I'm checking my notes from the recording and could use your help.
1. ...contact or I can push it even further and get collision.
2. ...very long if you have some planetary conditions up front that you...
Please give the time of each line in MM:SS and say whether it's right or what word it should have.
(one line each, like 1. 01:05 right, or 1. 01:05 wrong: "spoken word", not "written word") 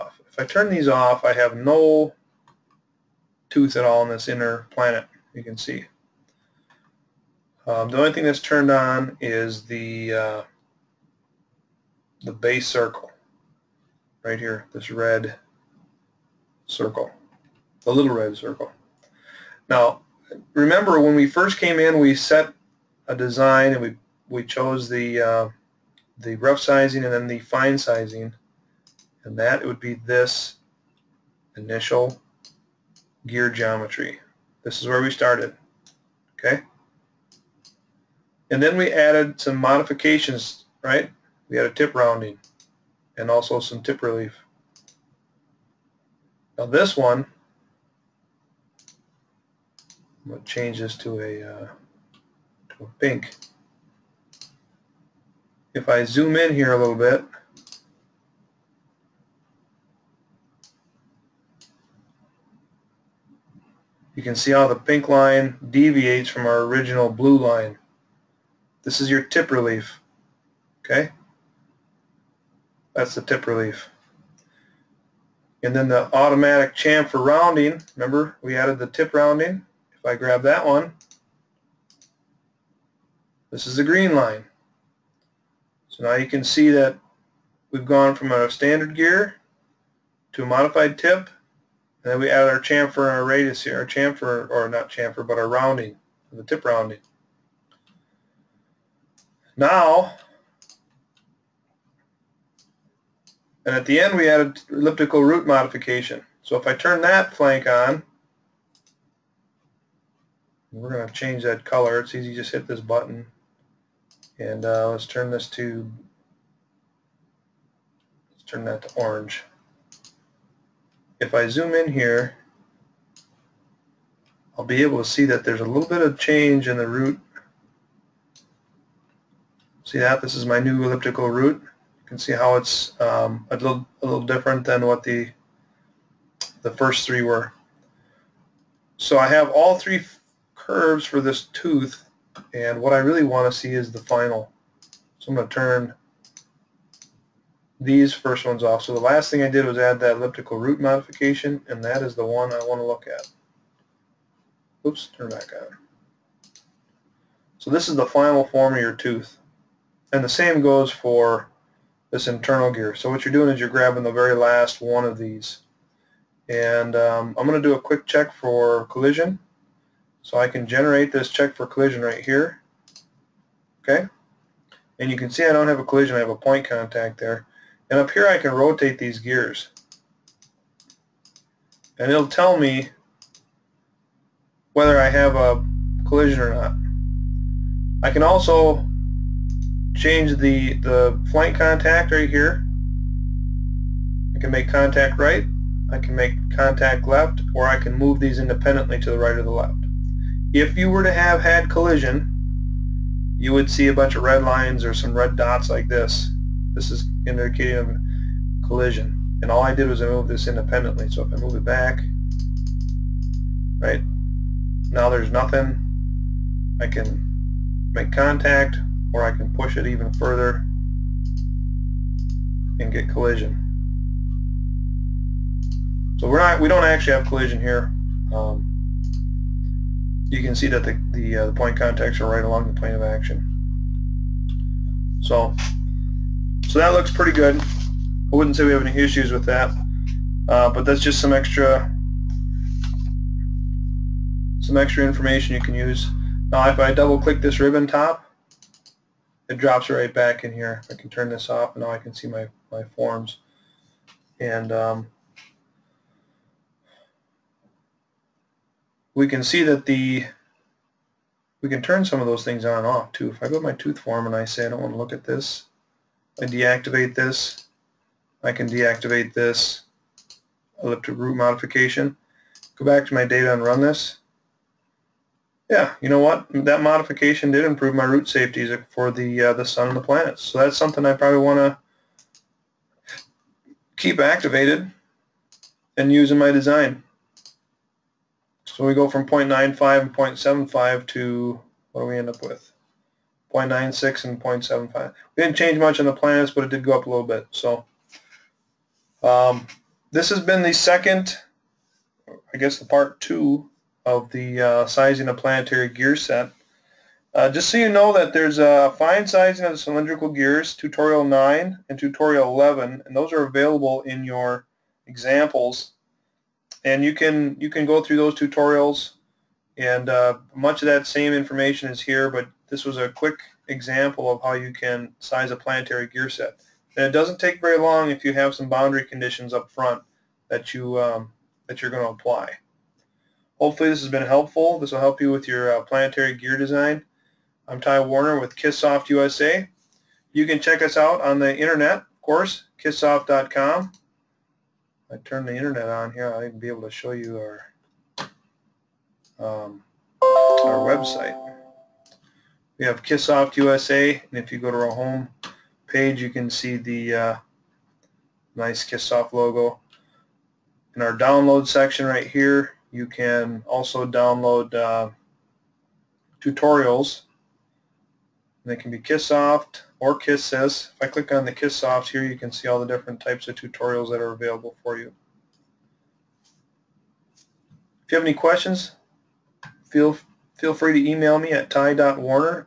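1. 03:38 right
2. 05:27 wrong: "boundary", not "planetary".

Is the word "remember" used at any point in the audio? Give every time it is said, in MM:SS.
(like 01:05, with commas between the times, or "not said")
00:20, 01:17.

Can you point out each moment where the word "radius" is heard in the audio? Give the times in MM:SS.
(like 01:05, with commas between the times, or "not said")
01:33.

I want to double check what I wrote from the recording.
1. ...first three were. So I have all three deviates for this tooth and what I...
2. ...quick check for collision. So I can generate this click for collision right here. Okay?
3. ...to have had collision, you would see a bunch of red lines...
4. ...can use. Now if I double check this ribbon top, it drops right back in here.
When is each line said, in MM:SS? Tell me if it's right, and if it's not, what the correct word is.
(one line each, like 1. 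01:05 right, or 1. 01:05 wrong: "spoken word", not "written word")
1. 02:16 wrong: "curves", not "deviates"
2. 02:47 wrong: "check", not "click"
3. 03:21 right
4. 04:05 wrong: "click", not "check".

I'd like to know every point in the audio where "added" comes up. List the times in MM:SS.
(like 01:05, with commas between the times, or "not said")
00:38, 01:18, 01:32, 01:44.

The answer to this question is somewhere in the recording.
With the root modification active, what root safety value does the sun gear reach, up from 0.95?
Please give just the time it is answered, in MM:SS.
04:53.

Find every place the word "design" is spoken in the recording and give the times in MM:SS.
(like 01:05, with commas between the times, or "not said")
00:23, 04:46, 05:36.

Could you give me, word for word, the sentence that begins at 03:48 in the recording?
Um, you can see that the, the, uh, the point contacts are right along the plane of action.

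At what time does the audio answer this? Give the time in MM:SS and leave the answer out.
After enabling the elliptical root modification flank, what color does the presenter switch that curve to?
01:58.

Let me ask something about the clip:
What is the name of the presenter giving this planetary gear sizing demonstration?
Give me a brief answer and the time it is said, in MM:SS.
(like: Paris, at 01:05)
Ty Warner, at 05:37.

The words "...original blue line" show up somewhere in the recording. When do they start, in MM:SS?
01:06.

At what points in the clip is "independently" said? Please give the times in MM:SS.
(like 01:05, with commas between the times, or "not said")
03:18, 03:30.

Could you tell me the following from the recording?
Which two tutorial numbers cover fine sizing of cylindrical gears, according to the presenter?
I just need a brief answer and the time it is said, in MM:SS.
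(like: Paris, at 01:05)
9 and 11, at 05:10.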